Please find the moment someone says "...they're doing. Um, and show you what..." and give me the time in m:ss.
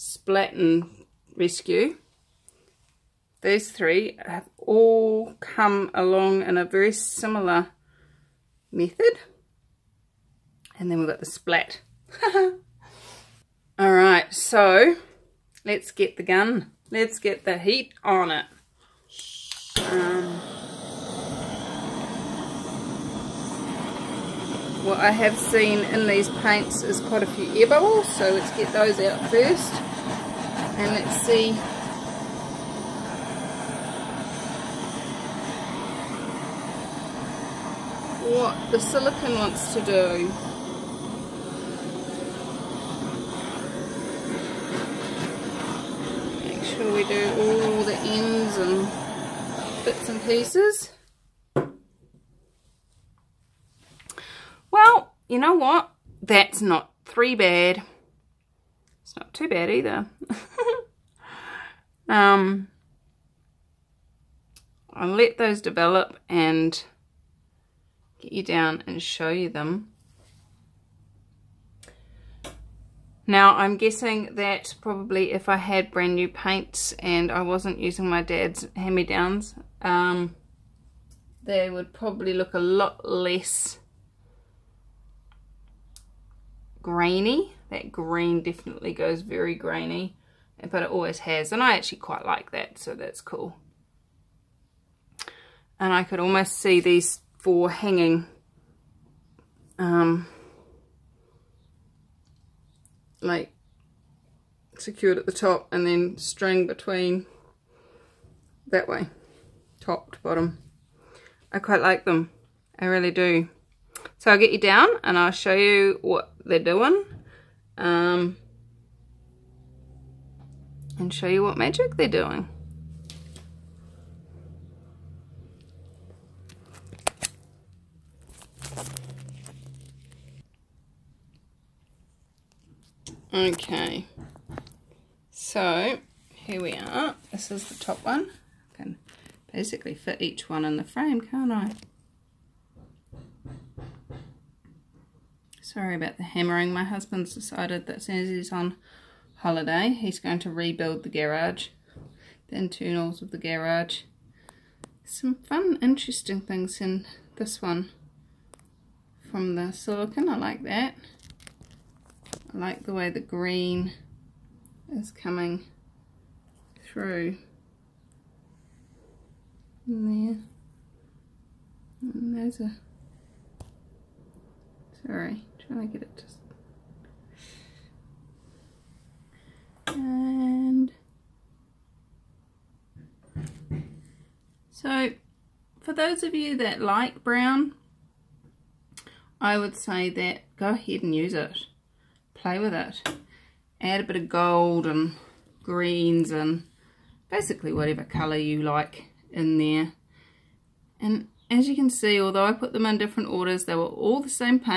1:56.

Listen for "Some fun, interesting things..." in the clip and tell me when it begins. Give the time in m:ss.
2:35.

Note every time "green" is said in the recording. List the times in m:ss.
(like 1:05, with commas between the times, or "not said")
1:27, 2:43, 3:15.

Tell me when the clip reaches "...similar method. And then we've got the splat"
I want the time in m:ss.
0:06.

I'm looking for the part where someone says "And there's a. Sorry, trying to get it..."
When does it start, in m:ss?
2:52.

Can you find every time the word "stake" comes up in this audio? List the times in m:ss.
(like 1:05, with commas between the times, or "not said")
not said.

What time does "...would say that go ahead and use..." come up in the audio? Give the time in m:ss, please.
3:09.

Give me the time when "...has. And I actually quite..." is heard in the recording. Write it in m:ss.
1:31.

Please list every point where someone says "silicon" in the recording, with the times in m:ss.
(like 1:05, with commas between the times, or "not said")
0:38, 2:39.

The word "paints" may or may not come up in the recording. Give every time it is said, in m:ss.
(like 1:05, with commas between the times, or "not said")
0:26, 1:16.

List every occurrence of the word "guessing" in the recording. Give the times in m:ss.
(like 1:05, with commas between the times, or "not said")
1:13.